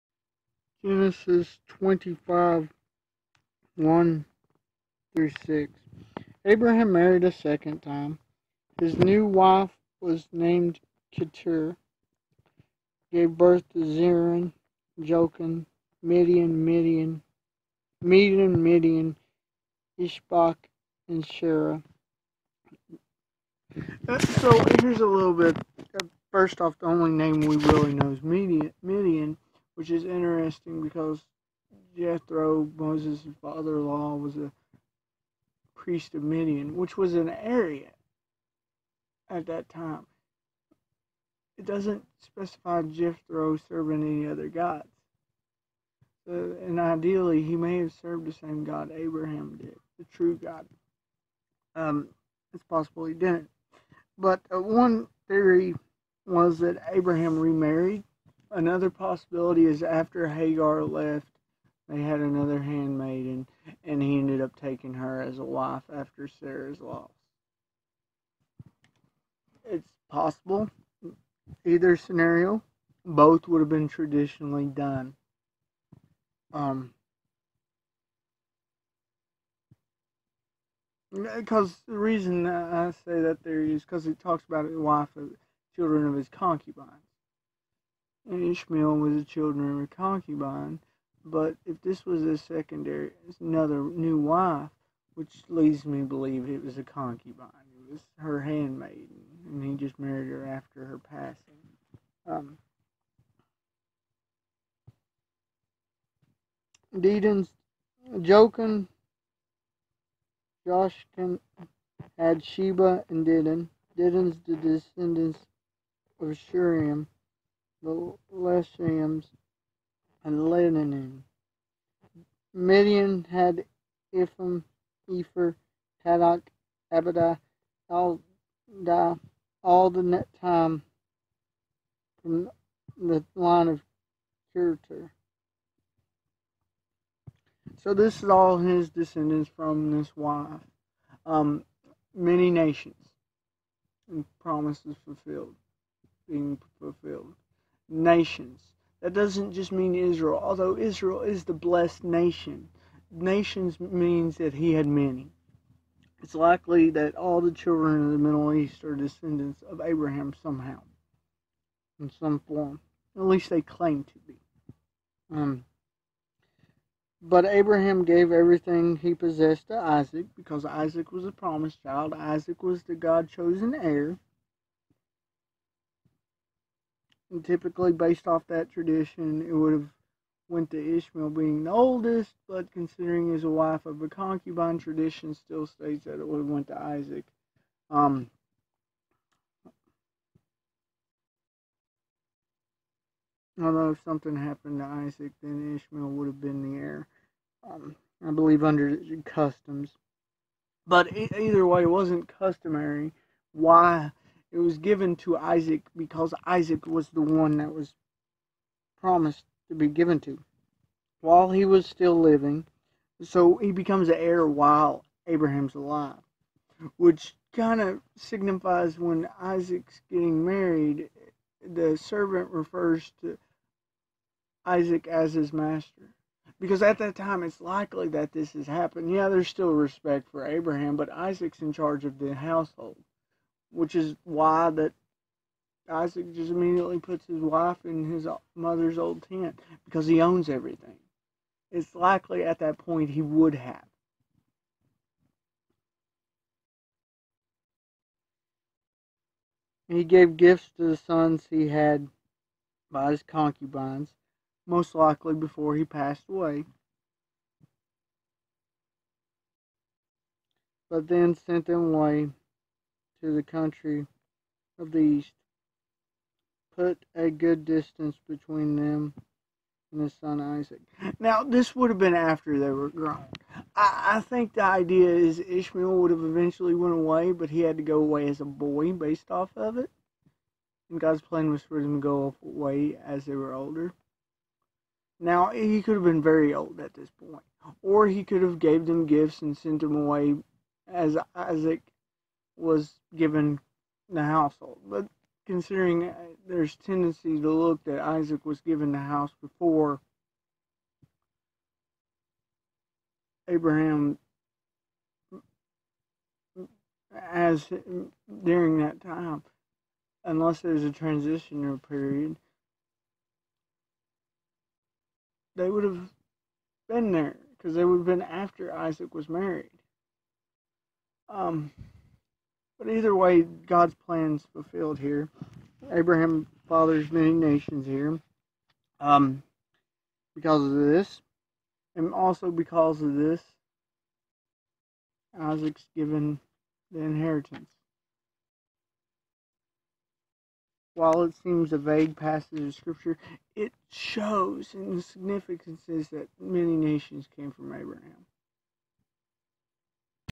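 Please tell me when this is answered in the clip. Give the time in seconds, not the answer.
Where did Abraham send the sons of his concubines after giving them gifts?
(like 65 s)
263 s.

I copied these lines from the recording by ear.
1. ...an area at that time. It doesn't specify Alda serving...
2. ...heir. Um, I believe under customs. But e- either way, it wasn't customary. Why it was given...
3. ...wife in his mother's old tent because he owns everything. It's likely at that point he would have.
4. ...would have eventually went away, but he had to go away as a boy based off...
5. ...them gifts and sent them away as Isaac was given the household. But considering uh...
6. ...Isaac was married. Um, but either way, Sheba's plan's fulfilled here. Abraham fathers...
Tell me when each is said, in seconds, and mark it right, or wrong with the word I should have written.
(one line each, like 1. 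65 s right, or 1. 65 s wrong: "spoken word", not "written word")
1. 37 s wrong: "Jethro", not "Alda"
2. 196 s right
3. 237 s right
4. 275 s right
5. 288 s right
6. 318 s wrong: "God", not "Sheba".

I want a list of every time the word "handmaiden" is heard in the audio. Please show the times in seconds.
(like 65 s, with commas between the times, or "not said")
62 s, 98 s.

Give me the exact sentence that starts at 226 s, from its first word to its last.
Because at that time, it's likely that this has happened.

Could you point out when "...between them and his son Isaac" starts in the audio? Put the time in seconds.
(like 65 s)
268 s.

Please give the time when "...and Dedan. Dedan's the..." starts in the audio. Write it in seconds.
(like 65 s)
113 s.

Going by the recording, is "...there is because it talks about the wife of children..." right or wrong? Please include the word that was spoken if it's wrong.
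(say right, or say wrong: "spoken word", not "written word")
right.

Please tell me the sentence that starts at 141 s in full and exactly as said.
Um, many nations and promises fulfilled, being fulfilled nations.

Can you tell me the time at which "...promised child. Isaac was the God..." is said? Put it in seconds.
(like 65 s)
171 s.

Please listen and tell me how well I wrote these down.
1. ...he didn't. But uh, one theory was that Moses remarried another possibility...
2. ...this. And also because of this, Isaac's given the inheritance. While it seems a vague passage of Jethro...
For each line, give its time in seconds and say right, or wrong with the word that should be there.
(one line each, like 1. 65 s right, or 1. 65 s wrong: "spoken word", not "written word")
1. 53 s wrong: "Abraham", not "Moses"
2. 330 s wrong: "Scripture", not "Jethro".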